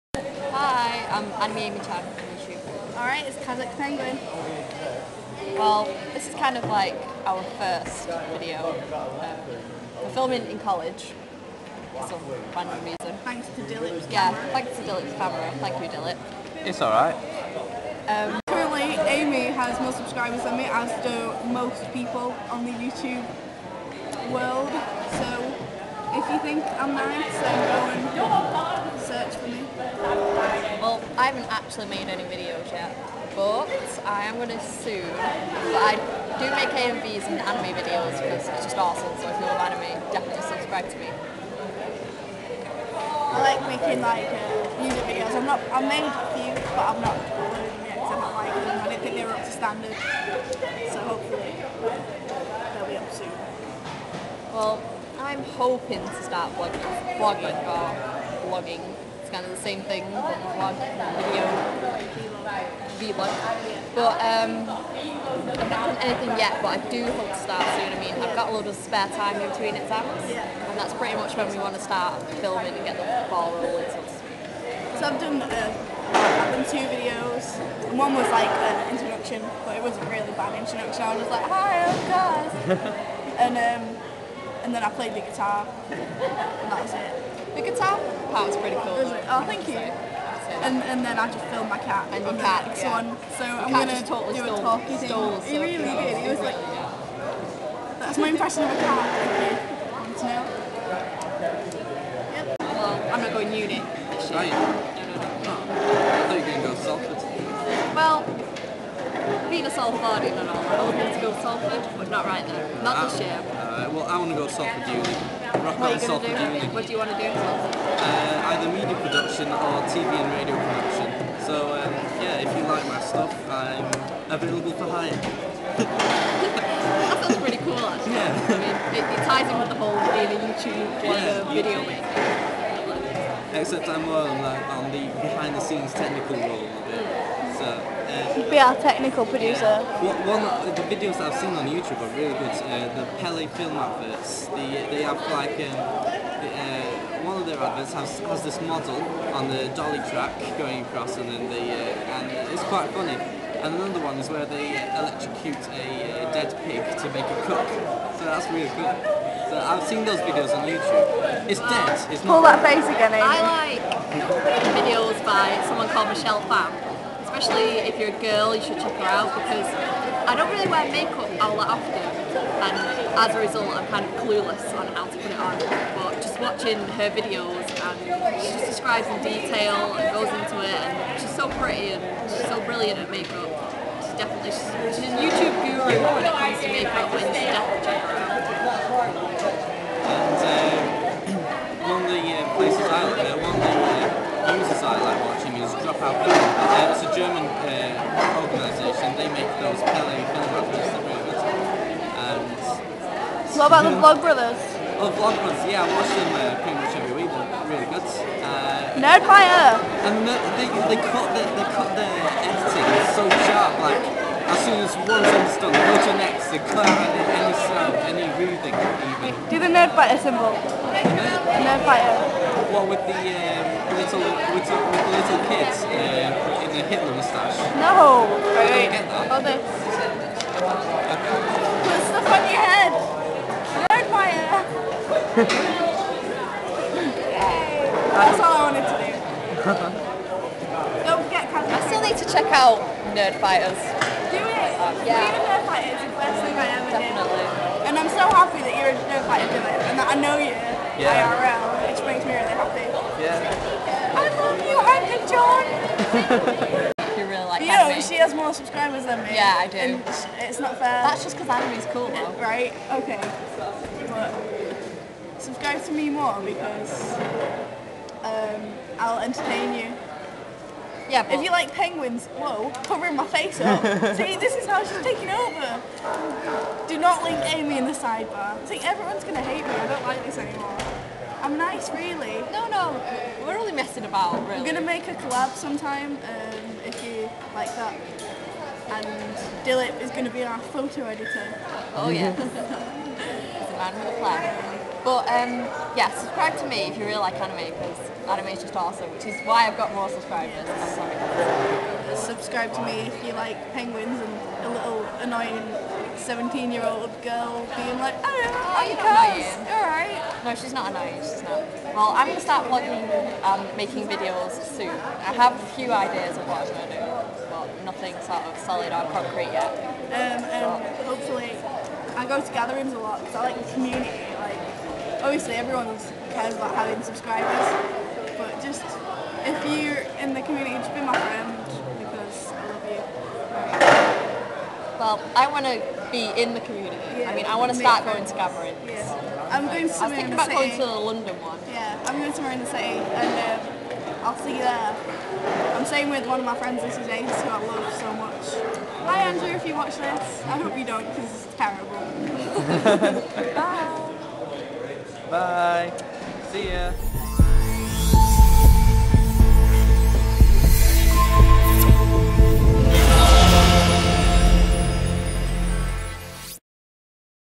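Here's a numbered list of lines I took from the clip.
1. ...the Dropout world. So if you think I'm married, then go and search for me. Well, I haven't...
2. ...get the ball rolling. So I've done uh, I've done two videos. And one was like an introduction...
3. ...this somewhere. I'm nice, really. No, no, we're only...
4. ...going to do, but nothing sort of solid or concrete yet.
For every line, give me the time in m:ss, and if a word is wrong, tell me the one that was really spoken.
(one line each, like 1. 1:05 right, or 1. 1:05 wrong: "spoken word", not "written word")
1. 0:22 wrong: "YouTube", not "Dropout"
2. 1:12 right
3. 4:40 wrong: "anymore", not "somewhere"
4. 5:16 right.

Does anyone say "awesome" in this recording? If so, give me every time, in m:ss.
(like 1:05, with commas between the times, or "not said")
0:38, 4:58.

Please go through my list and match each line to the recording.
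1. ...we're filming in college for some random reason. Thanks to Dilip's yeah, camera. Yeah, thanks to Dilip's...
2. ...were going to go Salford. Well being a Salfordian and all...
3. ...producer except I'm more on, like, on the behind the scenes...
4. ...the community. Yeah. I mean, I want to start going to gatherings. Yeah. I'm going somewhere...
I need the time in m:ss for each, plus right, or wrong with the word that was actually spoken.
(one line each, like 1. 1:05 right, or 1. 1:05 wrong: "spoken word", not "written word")
1. 0:10 right
2. 1:46 right
3. 2:11 wrong: "maker", not "producer"
4. 5:36 right.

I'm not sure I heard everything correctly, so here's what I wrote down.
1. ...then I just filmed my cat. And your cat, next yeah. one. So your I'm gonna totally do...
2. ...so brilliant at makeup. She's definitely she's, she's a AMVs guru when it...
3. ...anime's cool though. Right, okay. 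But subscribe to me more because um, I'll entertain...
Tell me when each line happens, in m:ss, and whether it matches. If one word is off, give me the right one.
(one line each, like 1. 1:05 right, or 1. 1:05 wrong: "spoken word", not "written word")
1. 1:31 right
2. 3:02 wrong: "YouTube", not "AMVs"
3. 4:21 right.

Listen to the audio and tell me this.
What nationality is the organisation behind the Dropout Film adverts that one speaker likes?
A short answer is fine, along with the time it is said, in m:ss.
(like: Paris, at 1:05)
German, at 3:17.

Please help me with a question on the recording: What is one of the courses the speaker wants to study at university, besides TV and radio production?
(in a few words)
Media production.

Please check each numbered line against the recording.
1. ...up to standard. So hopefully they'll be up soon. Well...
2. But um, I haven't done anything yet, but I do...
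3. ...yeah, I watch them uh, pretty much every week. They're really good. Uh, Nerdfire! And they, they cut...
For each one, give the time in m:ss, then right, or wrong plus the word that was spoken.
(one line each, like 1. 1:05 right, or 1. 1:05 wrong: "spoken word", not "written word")
1. 0:49 right
2. 1:03 right
3. 3:25 right.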